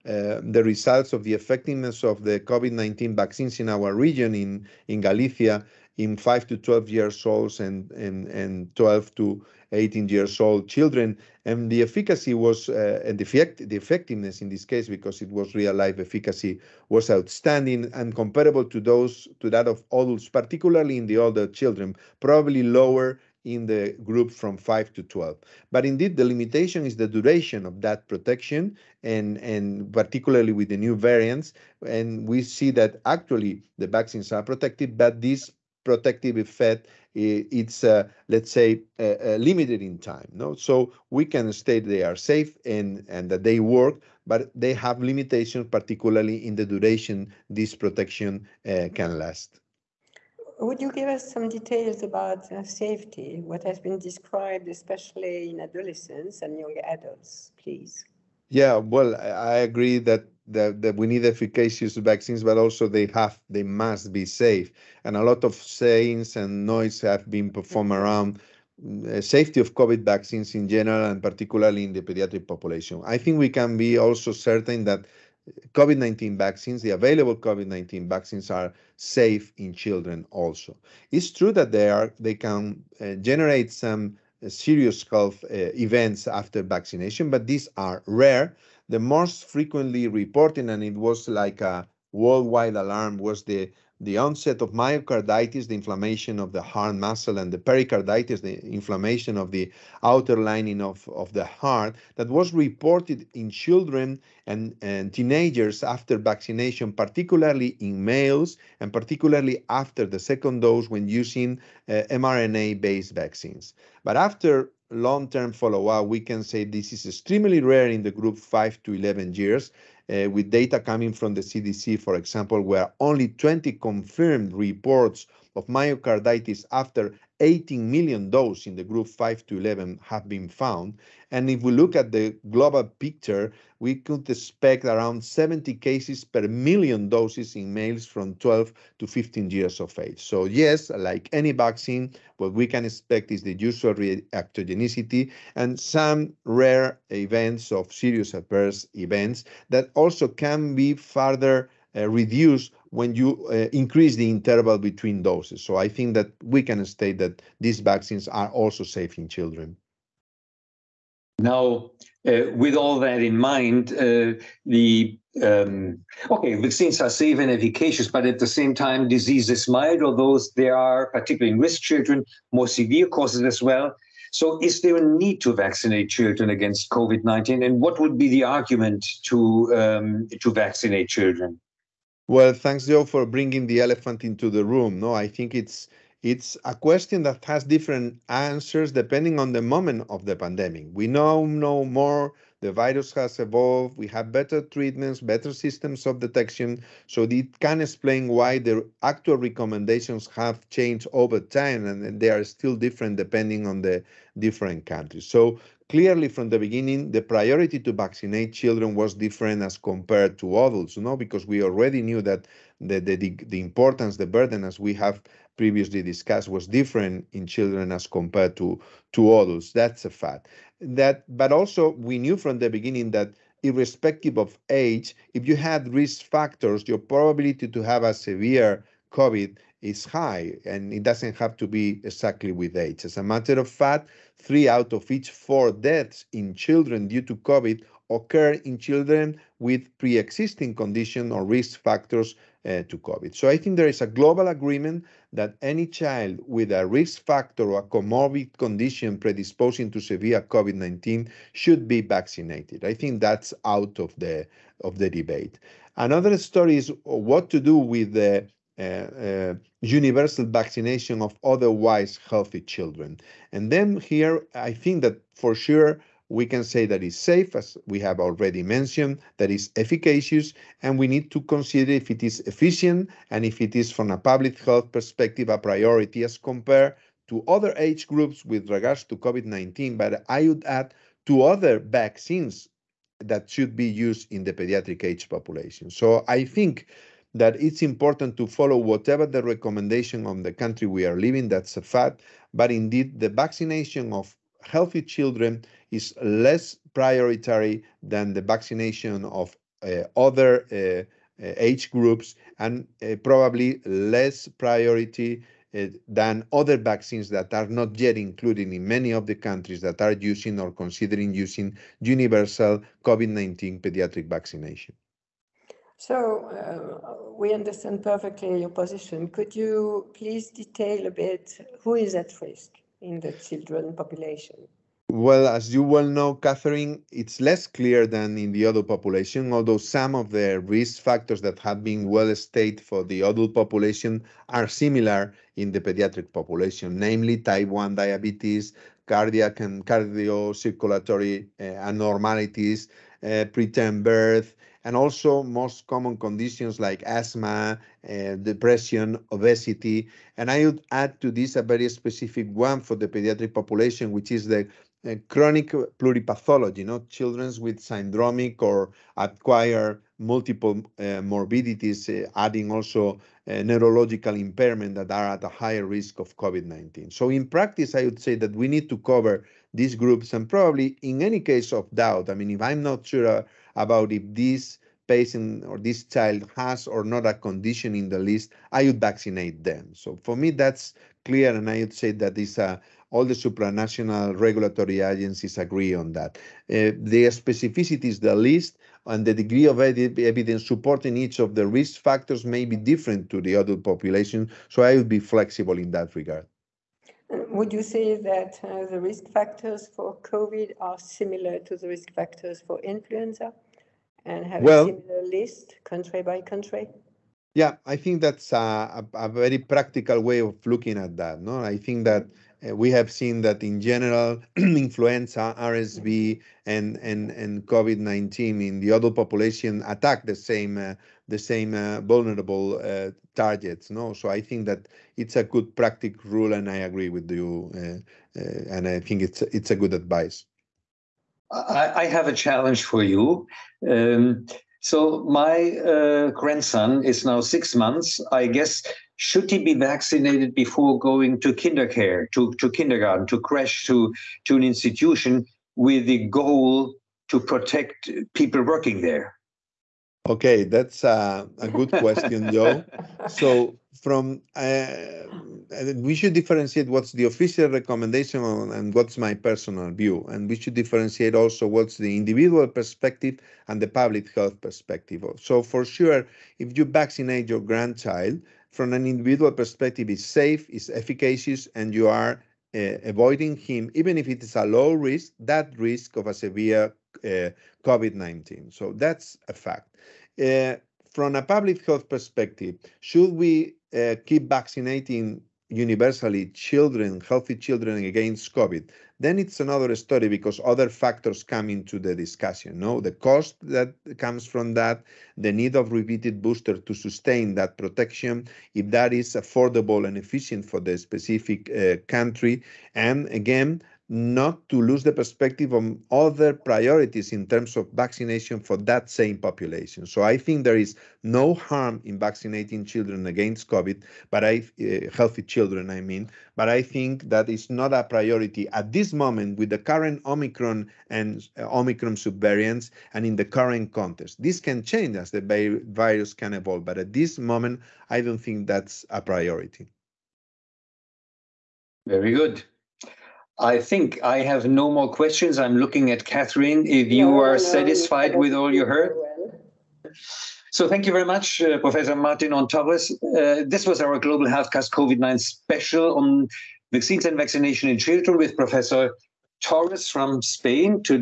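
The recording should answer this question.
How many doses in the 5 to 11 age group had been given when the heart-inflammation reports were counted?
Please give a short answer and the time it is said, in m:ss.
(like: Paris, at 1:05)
18 million, at 2:07.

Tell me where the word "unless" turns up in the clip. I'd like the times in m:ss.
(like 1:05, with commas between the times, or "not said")
not said.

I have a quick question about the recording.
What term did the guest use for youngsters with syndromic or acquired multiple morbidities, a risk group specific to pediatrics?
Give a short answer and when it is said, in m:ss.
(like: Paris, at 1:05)
chronic pluripathology, at 5:55.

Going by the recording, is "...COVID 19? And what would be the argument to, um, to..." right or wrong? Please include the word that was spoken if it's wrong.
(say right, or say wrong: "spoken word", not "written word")
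right.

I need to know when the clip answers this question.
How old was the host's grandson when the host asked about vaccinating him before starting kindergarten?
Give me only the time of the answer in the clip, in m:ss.
7:17.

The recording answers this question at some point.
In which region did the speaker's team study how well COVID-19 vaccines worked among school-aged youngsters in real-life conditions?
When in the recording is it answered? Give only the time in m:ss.
0:04.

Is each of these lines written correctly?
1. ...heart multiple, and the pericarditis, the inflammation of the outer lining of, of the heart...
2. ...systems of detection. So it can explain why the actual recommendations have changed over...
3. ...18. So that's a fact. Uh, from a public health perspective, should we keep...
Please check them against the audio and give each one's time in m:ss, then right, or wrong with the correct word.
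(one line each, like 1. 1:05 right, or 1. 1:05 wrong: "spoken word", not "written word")
1. 1:36 wrong: "muscle", not "multiple"
2. 3:15 right
3. 7:58 wrong: "19", not "18".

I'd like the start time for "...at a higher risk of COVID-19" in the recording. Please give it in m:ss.
6:05.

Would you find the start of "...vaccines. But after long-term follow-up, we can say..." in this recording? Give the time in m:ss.
1:53.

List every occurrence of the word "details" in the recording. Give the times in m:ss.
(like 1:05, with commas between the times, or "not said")
0:51, 5:20.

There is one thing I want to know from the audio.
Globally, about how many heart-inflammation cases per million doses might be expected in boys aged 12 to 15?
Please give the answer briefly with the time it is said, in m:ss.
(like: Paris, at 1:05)
70, at 2:15.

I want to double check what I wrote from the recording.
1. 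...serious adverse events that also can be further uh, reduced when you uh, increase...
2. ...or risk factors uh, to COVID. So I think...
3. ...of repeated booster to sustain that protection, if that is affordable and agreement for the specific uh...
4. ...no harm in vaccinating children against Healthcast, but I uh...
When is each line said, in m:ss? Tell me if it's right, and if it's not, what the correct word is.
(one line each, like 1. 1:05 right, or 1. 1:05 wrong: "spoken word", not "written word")
1. 2:27 right
2. 4:01 right
3. 8:15 wrong: "efficient", not "agreement"
4. 8:31 wrong: "COVID", not "Healthcast".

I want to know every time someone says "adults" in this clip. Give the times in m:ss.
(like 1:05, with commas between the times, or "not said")
0:19, 0:56, 3:30, 3:39, 5:28, 5:33, 6:33, 6:58.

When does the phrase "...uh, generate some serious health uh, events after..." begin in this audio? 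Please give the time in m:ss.
1:22.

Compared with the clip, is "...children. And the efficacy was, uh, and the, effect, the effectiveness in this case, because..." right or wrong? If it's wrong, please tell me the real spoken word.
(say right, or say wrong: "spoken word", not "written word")
right.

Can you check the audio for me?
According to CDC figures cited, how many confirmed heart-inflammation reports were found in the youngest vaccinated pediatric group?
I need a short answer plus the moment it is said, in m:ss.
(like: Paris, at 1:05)
20, at 2:03.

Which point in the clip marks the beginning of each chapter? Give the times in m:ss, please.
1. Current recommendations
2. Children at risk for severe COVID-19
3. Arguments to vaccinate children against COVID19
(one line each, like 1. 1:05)
1. 7:18
2. 5:18
3. 2:48.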